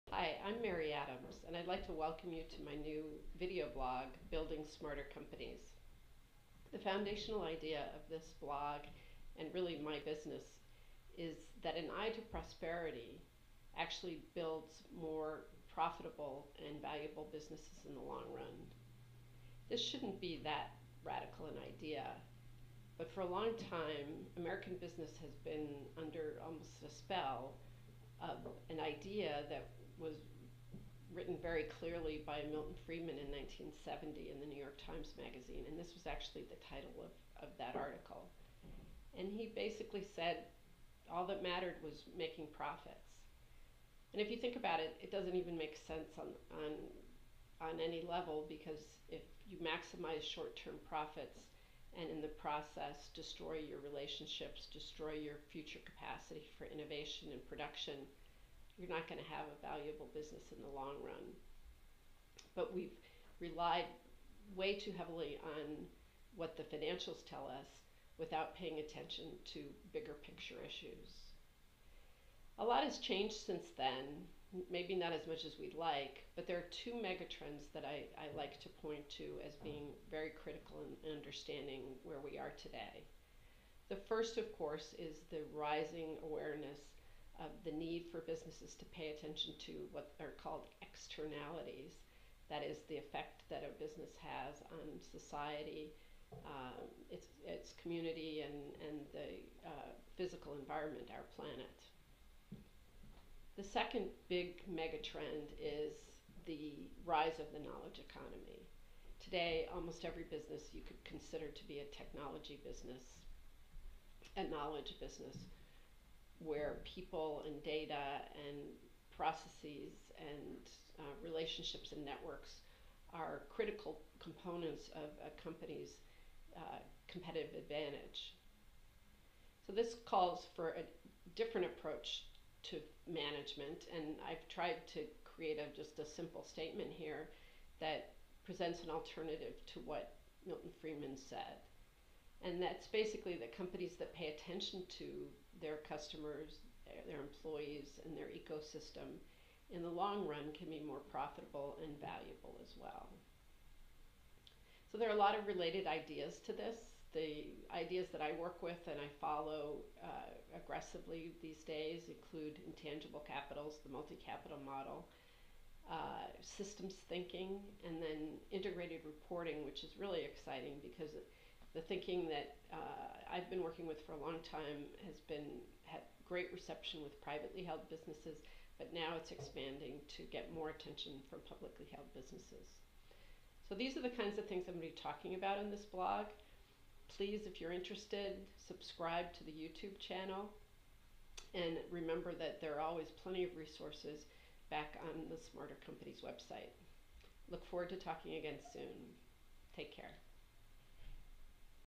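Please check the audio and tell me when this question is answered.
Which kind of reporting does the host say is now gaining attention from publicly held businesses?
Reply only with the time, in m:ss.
2:48.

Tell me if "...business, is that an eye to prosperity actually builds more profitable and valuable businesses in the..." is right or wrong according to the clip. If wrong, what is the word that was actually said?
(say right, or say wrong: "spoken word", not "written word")
right.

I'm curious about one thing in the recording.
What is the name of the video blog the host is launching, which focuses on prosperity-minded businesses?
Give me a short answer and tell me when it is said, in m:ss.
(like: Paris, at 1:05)
Building Smarter Companies, at 0:04.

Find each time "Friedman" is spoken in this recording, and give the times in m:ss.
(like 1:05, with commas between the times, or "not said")
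0:32, 2:20.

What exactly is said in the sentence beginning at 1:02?
But we've relied way too heavily on what the financials tell us without paying attention to bigger picture issues.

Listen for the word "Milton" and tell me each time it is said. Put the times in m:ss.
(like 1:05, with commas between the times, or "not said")
0:32, 2:20.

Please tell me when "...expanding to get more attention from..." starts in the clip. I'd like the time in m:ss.
2:59.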